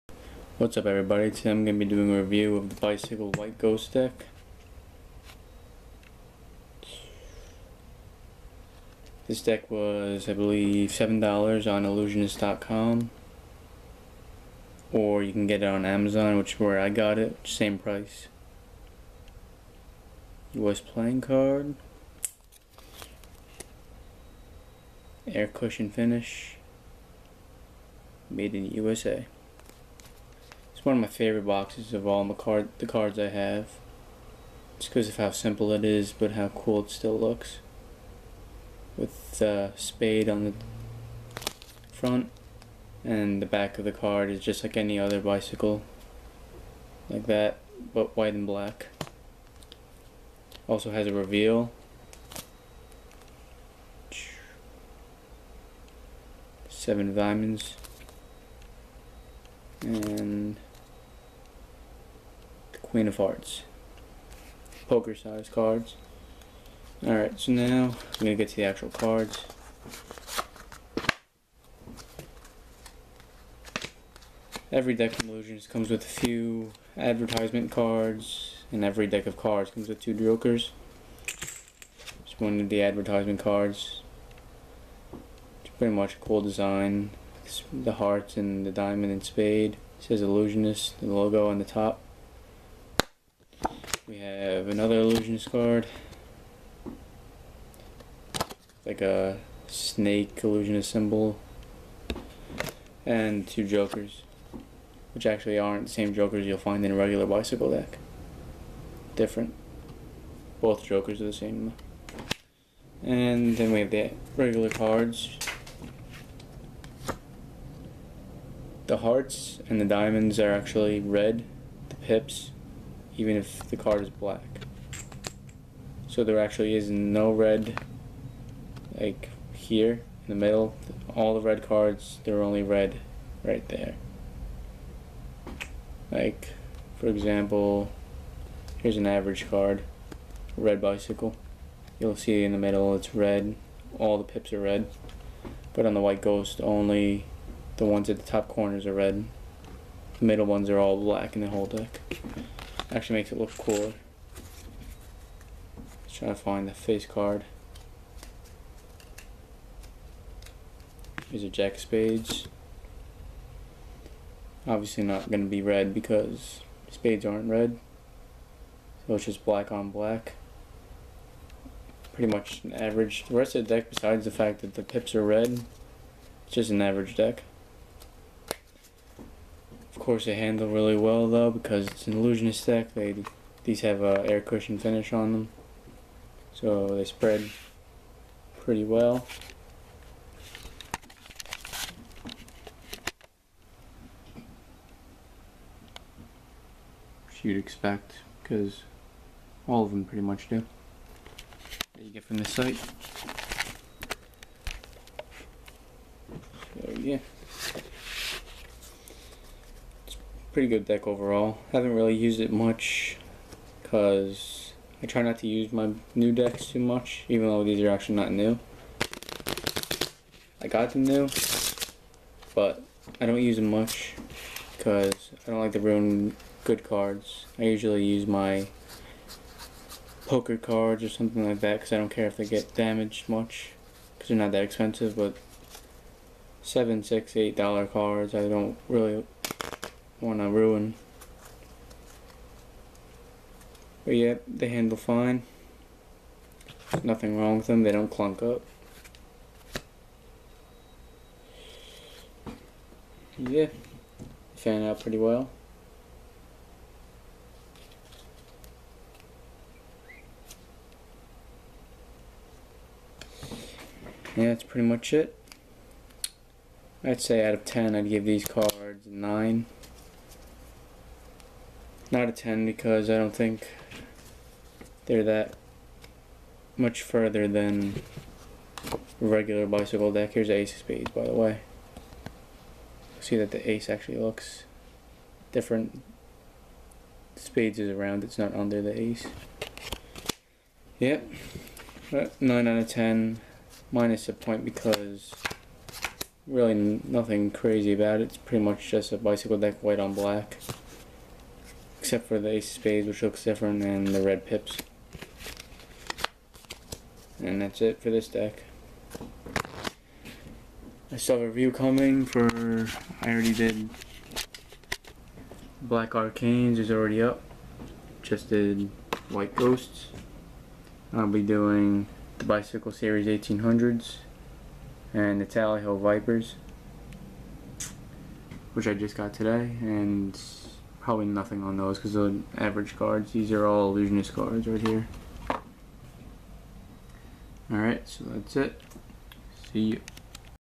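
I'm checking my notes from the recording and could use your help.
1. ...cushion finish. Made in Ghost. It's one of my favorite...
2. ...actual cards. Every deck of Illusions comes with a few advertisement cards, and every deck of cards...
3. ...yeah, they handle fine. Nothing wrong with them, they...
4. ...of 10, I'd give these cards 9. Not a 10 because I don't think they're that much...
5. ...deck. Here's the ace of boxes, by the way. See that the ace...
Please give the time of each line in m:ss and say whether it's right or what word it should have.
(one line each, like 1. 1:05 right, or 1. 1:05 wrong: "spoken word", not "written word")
1. 0:25 wrong: "USA", not "Ghost"
2. 1:08 right
3. 4:04 right
4. 4:27 right
5. 4:40 wrong: "spades", not "boxes".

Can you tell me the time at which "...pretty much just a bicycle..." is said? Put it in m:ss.
4:58.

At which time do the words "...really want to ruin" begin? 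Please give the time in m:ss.
3:58.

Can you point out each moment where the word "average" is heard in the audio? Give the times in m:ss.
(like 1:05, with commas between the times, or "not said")
2:19, 2:52, 2:56, 5:32.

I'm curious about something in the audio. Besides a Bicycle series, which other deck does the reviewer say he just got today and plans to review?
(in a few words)
Tally-Ho Vipers.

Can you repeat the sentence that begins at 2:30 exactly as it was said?
The middle ones are all black in the whole deck.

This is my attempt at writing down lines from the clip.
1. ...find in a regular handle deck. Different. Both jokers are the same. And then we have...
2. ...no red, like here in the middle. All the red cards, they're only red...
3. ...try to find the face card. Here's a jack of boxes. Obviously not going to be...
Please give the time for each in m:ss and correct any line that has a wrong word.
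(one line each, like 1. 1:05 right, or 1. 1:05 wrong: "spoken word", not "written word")
1. 1:46 wrong: "bicycle", not "handle"
2. 2:06 right
3. 2:36 wrong: "spades", not "boxes".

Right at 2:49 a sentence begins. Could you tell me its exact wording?
So it's just black on black.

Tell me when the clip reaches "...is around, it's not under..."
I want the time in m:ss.
4:47.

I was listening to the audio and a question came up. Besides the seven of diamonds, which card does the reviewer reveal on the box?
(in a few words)
Queen of Hearts.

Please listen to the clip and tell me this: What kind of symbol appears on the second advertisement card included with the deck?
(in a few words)
A snake.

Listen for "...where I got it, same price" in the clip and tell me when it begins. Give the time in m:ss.
0:16.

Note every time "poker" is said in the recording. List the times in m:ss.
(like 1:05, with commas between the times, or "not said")
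1:04, 3:50.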